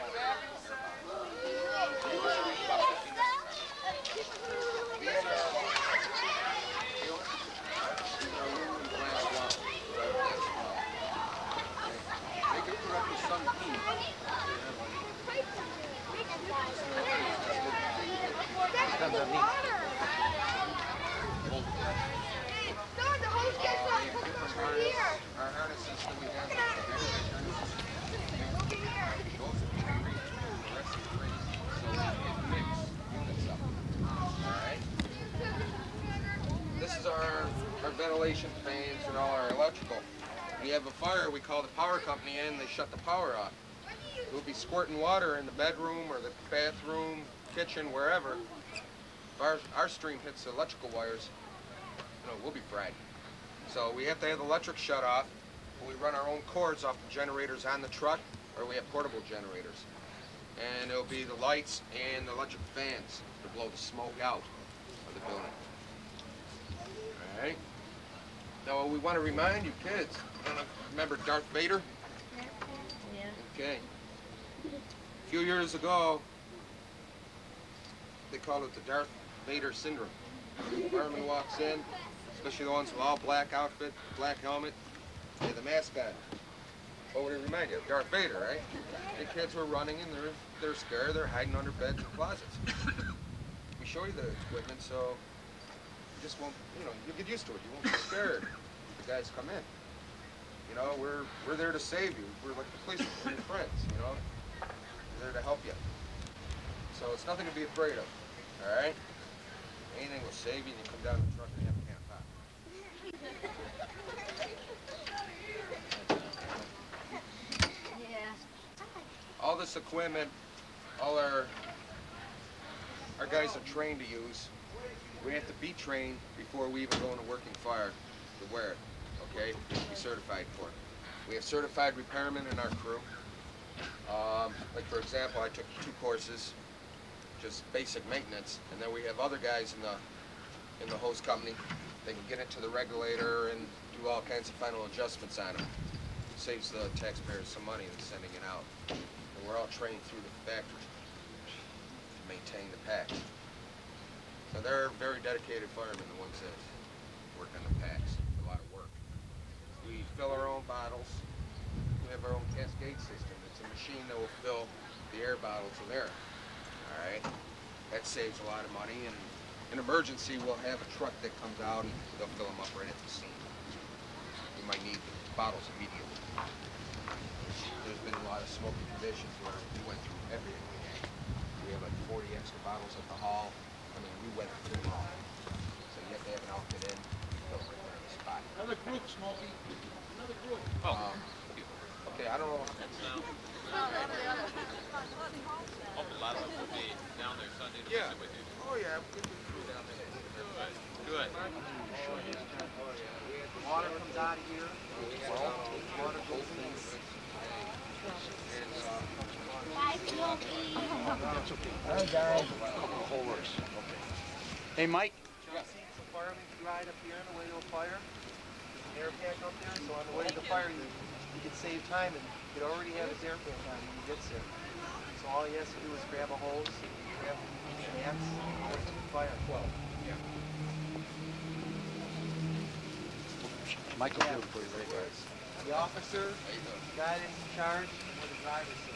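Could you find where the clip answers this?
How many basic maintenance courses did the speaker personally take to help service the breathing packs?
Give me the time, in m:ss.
2:15.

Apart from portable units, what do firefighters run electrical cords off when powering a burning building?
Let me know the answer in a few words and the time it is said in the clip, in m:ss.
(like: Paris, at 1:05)
generators on the truck, at 0:57.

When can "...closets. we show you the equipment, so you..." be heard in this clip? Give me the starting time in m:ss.
1:32.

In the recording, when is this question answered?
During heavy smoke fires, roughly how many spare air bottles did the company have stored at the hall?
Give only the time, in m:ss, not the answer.
3:02.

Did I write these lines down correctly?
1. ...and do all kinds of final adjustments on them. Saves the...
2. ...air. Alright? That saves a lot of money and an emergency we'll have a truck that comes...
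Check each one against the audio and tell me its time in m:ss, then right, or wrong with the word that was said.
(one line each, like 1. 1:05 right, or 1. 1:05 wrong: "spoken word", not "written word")
1. 2:23 right
2. 2:45 right.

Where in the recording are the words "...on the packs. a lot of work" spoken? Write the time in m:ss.
2:37.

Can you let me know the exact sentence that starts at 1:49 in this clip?
Anything will save you, and you come down the truck and have a camp out.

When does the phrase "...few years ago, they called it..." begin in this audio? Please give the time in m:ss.
1:15.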